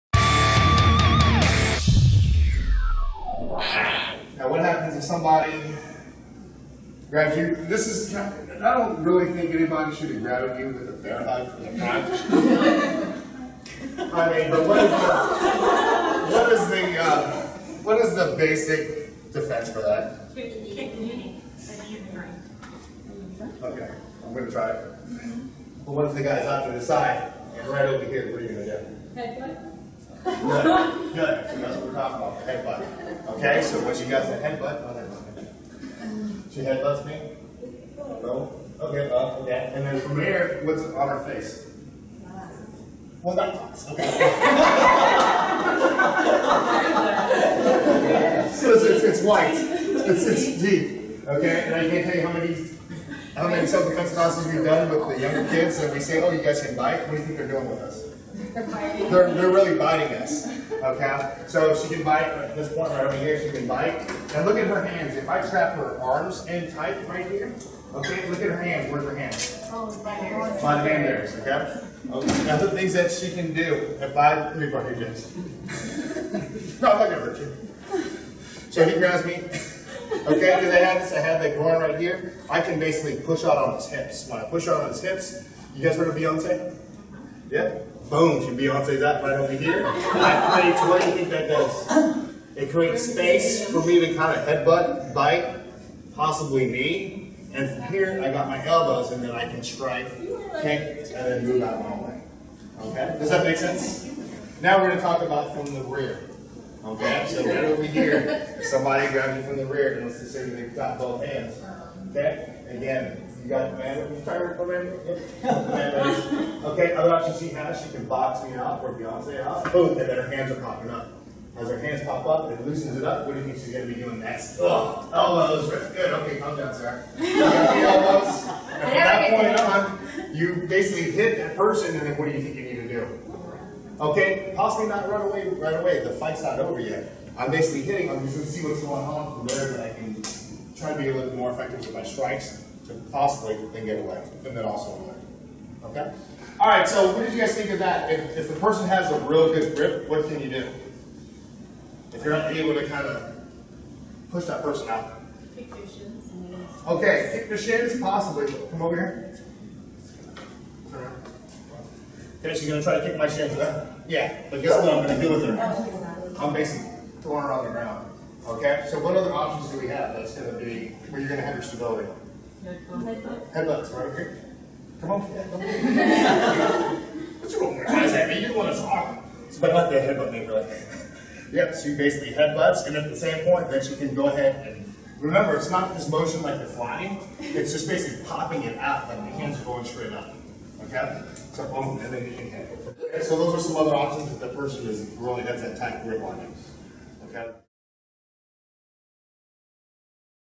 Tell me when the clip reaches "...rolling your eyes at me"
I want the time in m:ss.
2:57.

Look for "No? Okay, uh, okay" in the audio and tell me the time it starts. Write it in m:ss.
0:37.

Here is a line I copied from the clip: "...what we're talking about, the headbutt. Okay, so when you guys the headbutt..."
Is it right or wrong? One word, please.
right.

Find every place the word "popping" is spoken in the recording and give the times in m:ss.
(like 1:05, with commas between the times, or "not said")
2:00, 3:08.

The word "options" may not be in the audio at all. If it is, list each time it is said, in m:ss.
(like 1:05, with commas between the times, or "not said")
1:57, 2:49, 3:13.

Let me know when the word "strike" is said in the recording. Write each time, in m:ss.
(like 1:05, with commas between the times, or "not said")
1:39, 2:22.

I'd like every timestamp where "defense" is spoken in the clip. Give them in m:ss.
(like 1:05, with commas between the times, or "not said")
0:19, 0:53.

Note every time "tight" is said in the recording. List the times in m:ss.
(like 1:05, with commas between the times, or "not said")
1:06, 3:15.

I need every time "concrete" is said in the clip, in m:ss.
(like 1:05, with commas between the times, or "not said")
not said.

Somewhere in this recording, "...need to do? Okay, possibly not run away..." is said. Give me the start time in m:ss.
2:12.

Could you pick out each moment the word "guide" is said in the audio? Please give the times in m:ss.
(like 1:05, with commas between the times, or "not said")
not said.